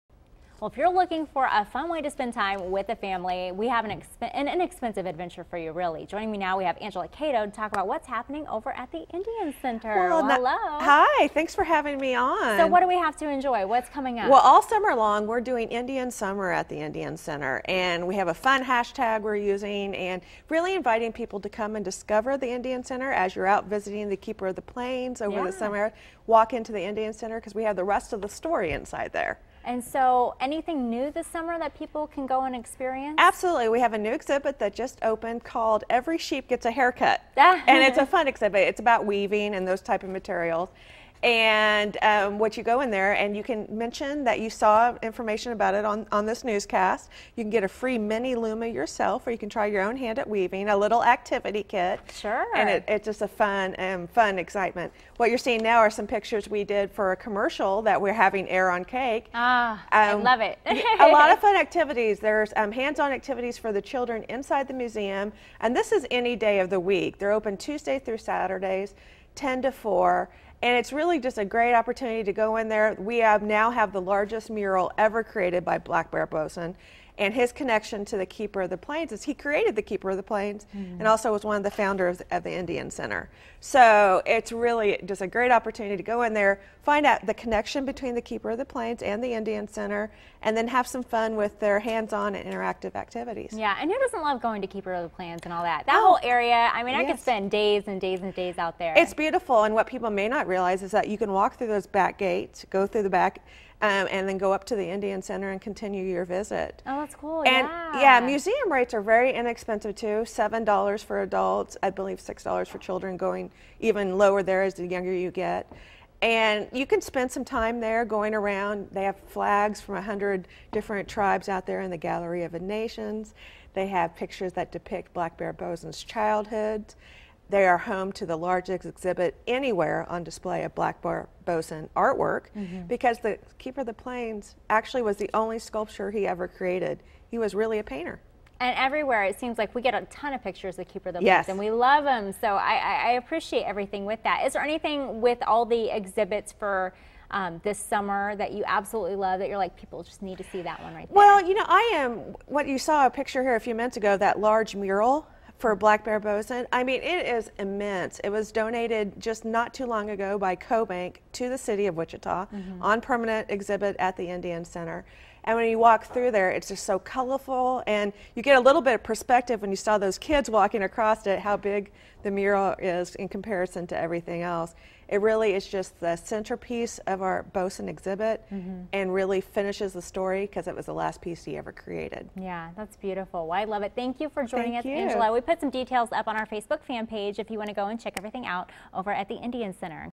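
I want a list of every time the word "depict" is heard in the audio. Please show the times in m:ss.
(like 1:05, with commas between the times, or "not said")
2:04.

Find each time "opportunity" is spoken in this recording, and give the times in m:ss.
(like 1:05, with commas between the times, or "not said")
1:11, 1:25.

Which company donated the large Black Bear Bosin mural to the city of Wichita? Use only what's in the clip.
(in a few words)
CoBank.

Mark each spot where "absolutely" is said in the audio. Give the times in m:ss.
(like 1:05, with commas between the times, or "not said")
0:33, 2:28.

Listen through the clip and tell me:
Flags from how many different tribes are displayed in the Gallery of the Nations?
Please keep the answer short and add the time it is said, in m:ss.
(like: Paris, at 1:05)
100, at 1:59.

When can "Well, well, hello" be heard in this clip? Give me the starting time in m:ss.
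0:10.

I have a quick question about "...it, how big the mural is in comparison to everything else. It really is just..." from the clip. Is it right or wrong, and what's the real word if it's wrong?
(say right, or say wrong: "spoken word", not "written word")
right.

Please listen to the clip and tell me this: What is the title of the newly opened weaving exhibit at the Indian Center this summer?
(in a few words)
Every Sheep Gets a Haircut.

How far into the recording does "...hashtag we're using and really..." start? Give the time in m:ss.
0:18.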